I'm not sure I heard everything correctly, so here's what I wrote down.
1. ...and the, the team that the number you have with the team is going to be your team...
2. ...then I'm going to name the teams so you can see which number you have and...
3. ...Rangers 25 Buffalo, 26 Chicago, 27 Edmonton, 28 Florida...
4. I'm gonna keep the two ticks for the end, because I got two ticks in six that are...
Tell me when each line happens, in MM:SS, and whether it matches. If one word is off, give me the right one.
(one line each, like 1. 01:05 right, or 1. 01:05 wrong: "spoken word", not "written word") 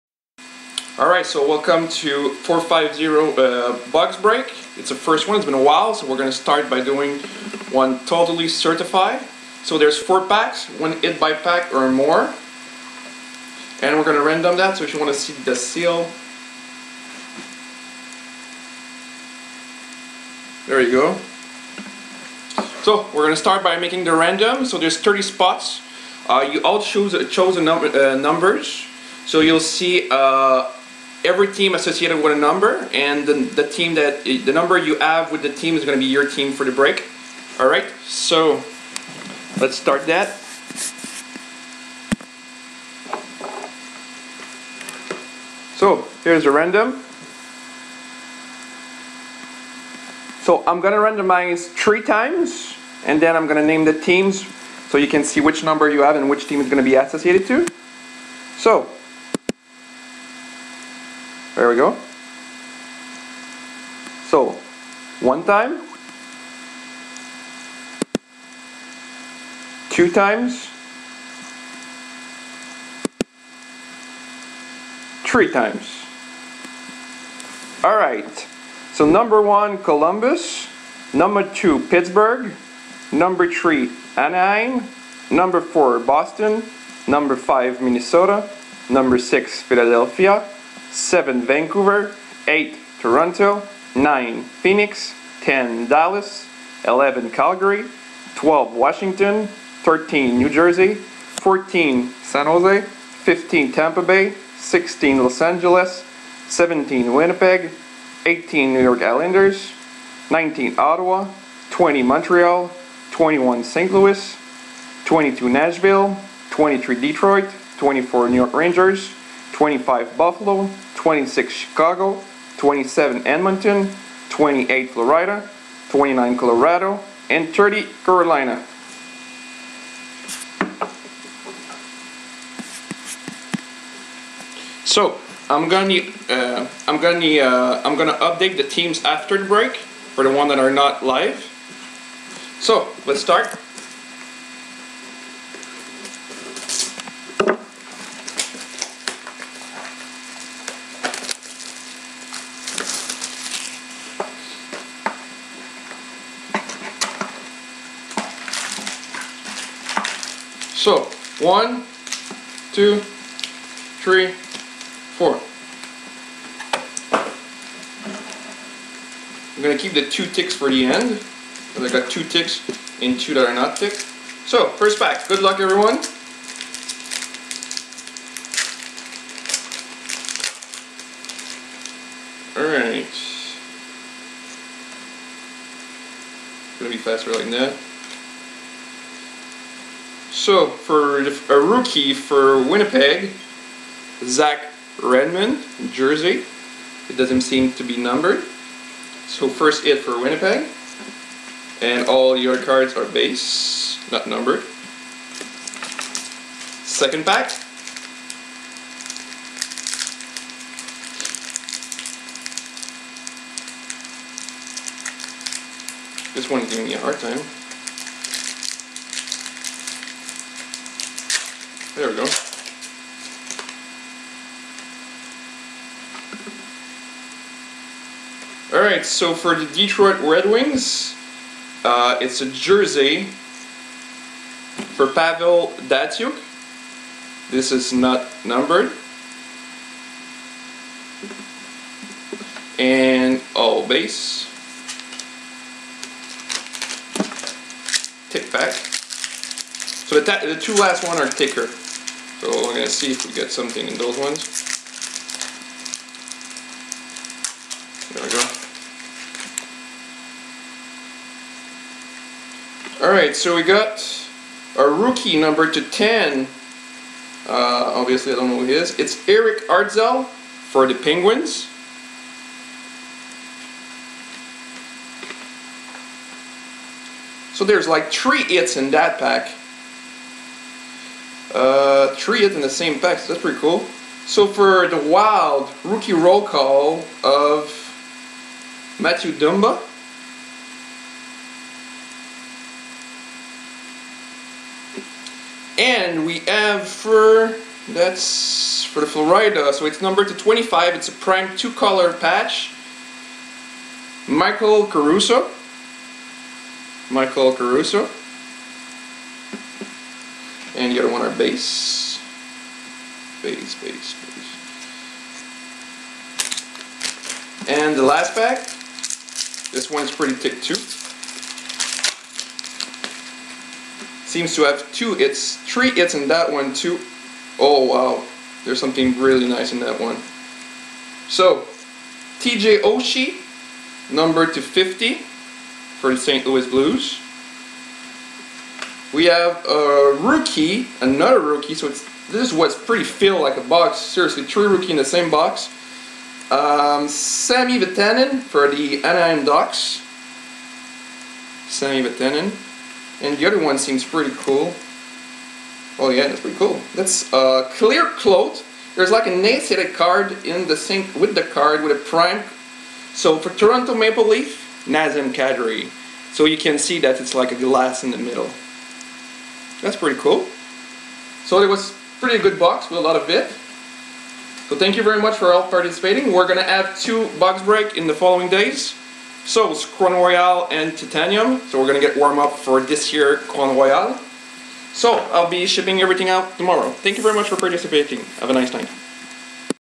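1. 00:32 right
2. 00:53 right
3. 01:58 right
4. 02:49 wrong: "two", not "six".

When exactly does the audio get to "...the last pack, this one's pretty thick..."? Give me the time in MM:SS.
05:17.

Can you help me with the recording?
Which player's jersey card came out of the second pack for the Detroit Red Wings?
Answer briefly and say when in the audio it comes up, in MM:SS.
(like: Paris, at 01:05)
Pavel Datsyuk, at 03:55.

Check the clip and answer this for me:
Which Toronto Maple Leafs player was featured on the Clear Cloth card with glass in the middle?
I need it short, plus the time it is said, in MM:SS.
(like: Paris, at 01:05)
Nazem Kadri, at 06:04.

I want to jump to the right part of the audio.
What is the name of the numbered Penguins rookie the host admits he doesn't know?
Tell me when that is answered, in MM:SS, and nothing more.
04:29.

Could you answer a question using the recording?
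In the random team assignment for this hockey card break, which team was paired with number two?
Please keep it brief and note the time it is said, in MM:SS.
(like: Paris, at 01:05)
Pittsburgh, at 01:21.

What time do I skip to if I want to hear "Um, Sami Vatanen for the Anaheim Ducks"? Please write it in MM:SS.
05:46.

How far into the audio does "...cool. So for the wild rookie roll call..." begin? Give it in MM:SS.
04:43.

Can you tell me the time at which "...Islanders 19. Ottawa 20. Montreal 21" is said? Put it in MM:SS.
01:49.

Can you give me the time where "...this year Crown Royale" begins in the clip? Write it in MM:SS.
06:22.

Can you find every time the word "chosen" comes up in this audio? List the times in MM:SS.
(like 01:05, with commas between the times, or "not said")
00:27.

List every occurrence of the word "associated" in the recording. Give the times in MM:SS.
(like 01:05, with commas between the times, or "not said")
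00:31, 00:56.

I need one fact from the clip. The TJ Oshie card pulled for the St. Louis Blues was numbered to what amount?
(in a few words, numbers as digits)
250.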